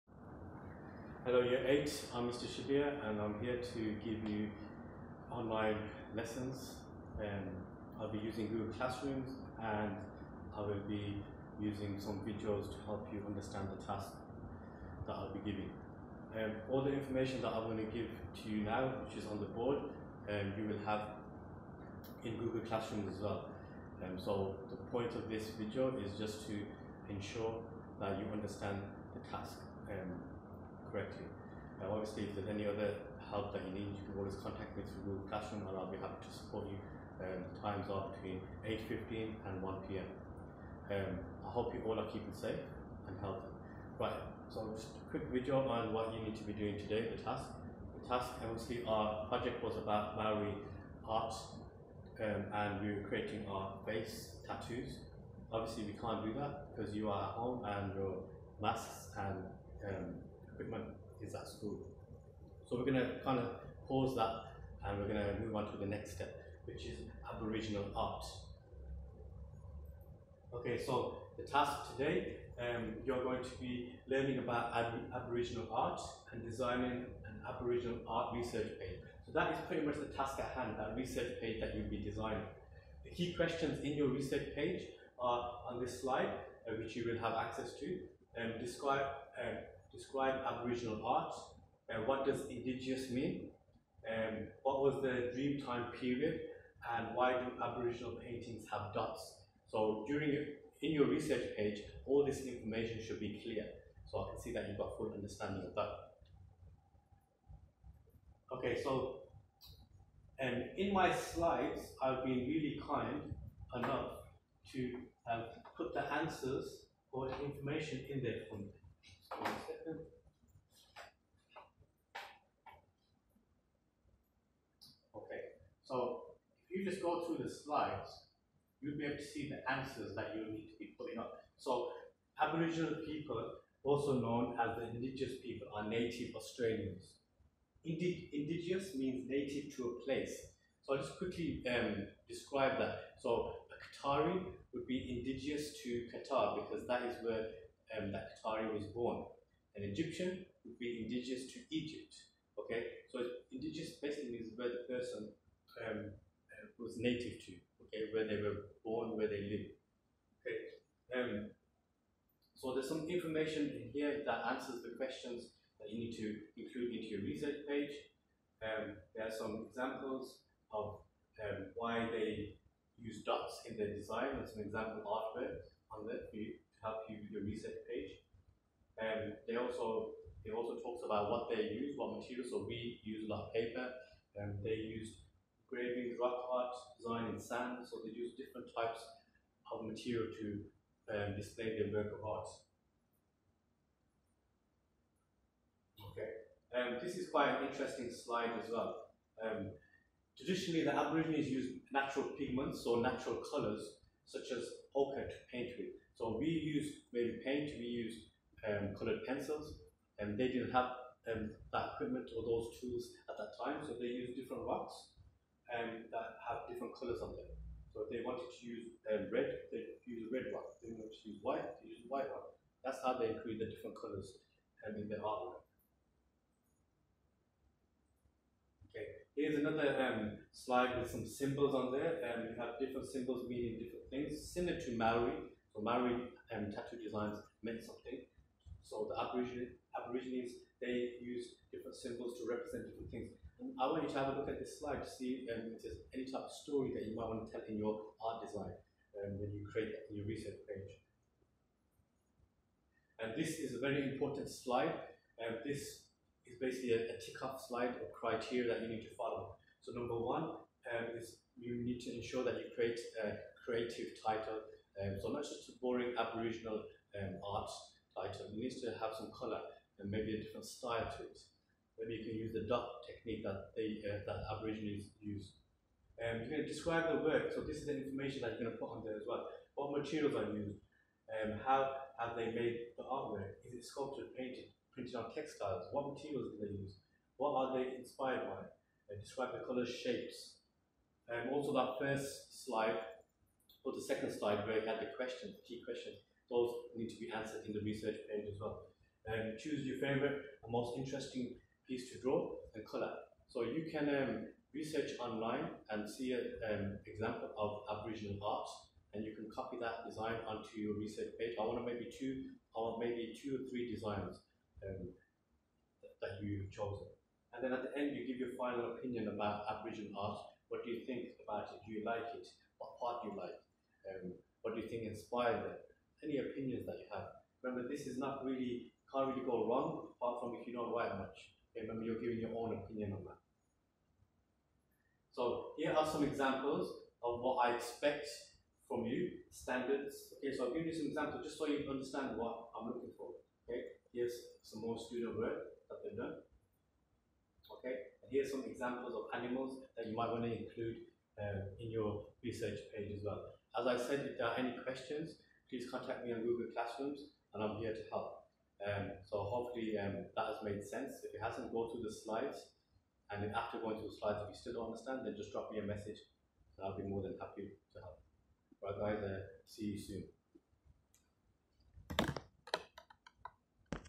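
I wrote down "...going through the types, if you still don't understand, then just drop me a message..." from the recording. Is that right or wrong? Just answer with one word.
wrong.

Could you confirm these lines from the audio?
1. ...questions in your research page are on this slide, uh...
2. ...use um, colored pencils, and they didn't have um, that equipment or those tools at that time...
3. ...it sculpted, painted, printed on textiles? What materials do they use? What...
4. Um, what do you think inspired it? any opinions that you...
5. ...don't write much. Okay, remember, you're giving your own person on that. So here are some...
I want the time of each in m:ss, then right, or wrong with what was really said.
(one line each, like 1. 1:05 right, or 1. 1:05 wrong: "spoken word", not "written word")
1. 1:23 right
2. 3:27 right
3. 4:43 right
4. 5:24 right
5. 5:30 wrong: "opinion", not "person".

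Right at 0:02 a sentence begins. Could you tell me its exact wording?
Shabir, and I'm here to give you online lessons.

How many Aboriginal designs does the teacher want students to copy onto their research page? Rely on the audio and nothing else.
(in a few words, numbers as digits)
2 or 3.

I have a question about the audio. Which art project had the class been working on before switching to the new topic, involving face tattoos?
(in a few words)
Maori art.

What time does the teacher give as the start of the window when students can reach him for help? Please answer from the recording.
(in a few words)
8:15.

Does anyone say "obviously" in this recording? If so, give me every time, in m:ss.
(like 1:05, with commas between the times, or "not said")
0:31, 0:48, 0:55.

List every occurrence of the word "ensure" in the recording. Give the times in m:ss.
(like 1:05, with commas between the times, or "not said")
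0:27, 4:22.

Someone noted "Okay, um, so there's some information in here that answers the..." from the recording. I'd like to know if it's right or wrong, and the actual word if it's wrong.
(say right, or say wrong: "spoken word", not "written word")
right.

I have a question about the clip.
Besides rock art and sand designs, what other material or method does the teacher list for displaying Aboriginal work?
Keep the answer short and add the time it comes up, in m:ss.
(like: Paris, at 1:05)
graving, at 3:05.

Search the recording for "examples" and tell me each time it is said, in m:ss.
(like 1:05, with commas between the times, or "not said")
2:49, 2:54, 5:07, 5:36, 5:41, 5:48.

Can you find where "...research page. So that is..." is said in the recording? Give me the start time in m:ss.
1:18.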